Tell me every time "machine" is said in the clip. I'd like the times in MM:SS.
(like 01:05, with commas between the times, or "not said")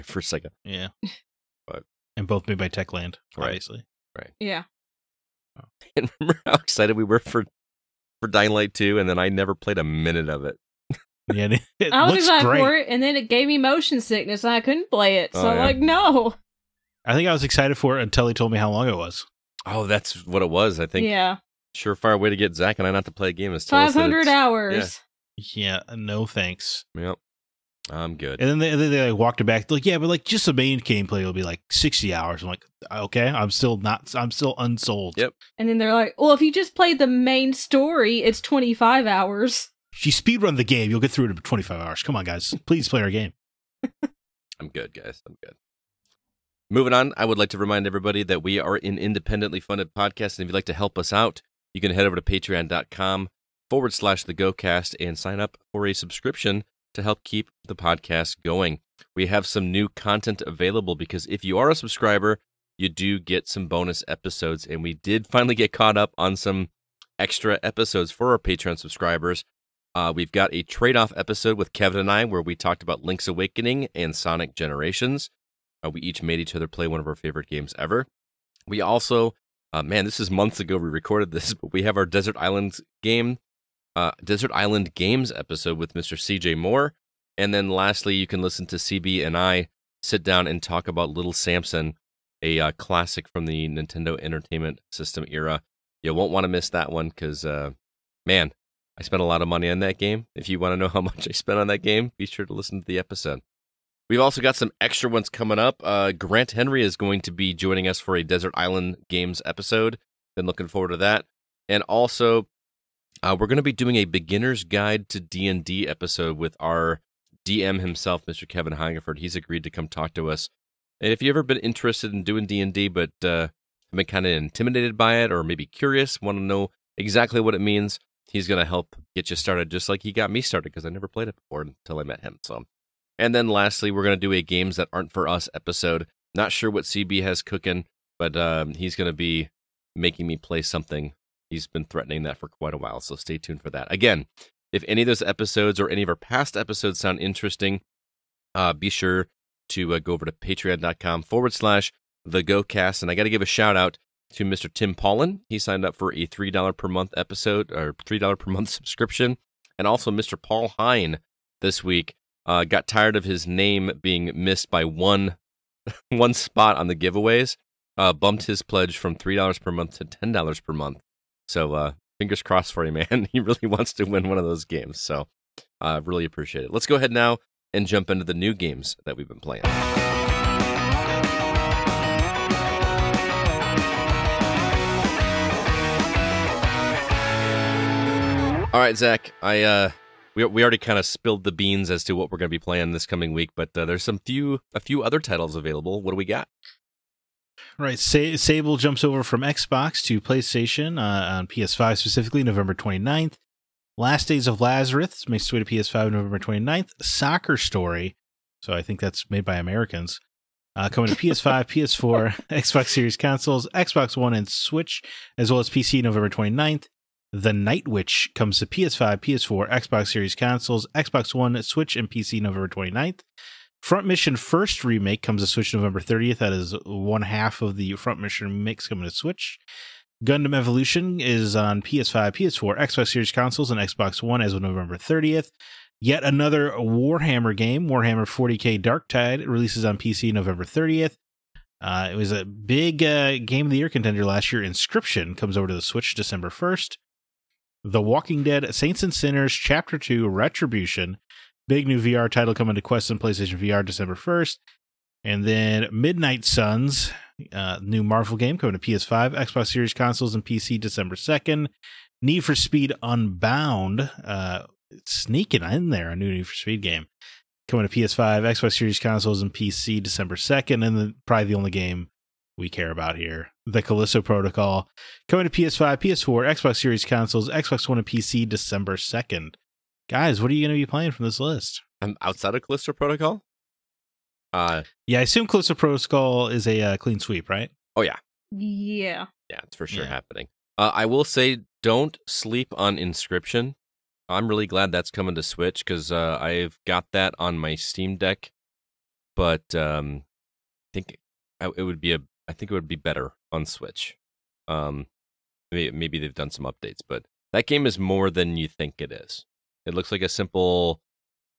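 not said.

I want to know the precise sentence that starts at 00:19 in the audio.
Oh, that's what it was, I think.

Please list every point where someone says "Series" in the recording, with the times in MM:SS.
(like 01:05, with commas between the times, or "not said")
03:32, 03:40, 03:53, 04:19, 04:28, 04:36.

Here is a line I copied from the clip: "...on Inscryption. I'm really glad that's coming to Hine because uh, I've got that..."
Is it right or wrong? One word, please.
wrong.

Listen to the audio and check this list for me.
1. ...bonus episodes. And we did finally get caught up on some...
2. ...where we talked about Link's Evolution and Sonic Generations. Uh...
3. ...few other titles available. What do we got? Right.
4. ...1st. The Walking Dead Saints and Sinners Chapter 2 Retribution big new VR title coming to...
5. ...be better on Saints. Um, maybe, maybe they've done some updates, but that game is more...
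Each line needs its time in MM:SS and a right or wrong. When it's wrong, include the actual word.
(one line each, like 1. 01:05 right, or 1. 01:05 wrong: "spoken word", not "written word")
1. 01:03 right
2. 01:12 wrong: "Awakening", not "Evolution"
3. 03:14 right
4. 04:06 right
5. 05:02 wrong: "Switch", not "Saints".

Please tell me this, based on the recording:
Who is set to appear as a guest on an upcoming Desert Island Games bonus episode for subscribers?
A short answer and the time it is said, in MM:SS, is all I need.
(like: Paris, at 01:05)
Grant Henry, at 01:46.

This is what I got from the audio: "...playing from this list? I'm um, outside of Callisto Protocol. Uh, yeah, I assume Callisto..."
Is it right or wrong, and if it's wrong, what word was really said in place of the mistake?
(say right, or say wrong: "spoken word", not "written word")
right.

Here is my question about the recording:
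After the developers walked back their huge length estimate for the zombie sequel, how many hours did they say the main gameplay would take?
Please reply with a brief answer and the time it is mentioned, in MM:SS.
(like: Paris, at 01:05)
60 hours, at 00:31.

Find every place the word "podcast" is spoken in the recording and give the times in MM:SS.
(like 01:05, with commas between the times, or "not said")
00:49, 00:57.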